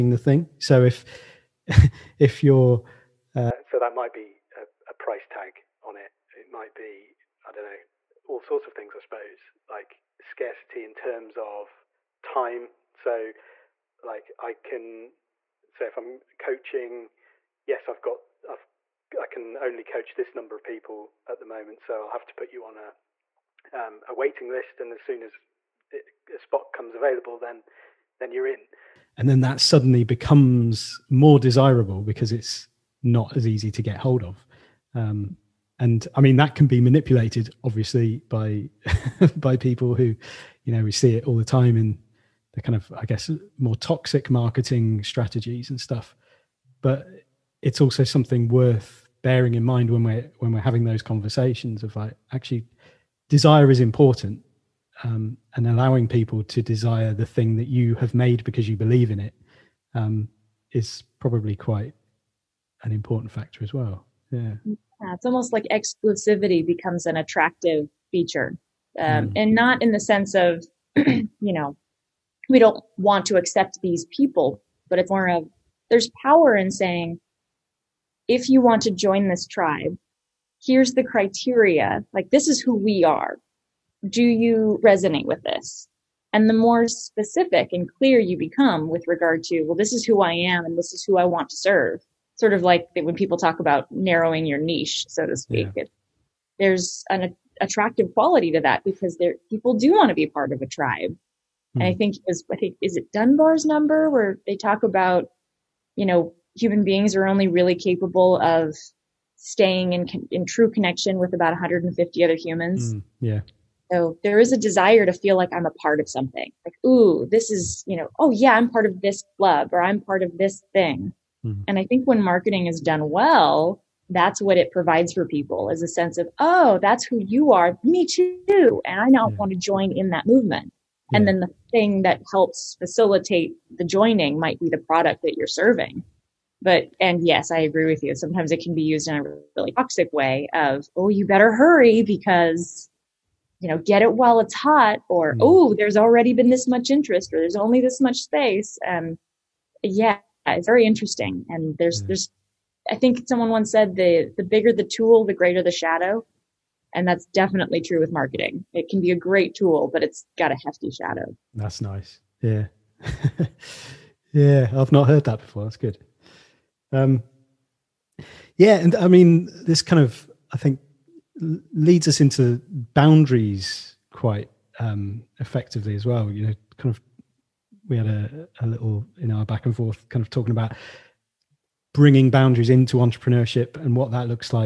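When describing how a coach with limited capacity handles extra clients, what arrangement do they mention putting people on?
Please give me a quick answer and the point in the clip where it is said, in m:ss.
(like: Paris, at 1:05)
waiting list, at 0:24.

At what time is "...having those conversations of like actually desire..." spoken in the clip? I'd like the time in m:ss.
0:50.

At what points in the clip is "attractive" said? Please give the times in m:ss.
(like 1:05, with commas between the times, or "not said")
1:07, 1:37.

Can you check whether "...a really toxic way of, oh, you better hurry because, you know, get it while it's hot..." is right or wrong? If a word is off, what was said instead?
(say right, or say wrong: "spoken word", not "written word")
right.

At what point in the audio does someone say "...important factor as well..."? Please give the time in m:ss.
1:02.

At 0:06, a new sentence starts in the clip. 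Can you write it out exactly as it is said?
It might be, I don't know, all sorts of things, I suppose, like scarcity in terms of time.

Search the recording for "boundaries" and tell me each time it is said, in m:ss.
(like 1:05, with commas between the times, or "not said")
2:52, 3:02.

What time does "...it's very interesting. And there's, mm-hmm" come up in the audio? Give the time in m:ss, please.
2:30.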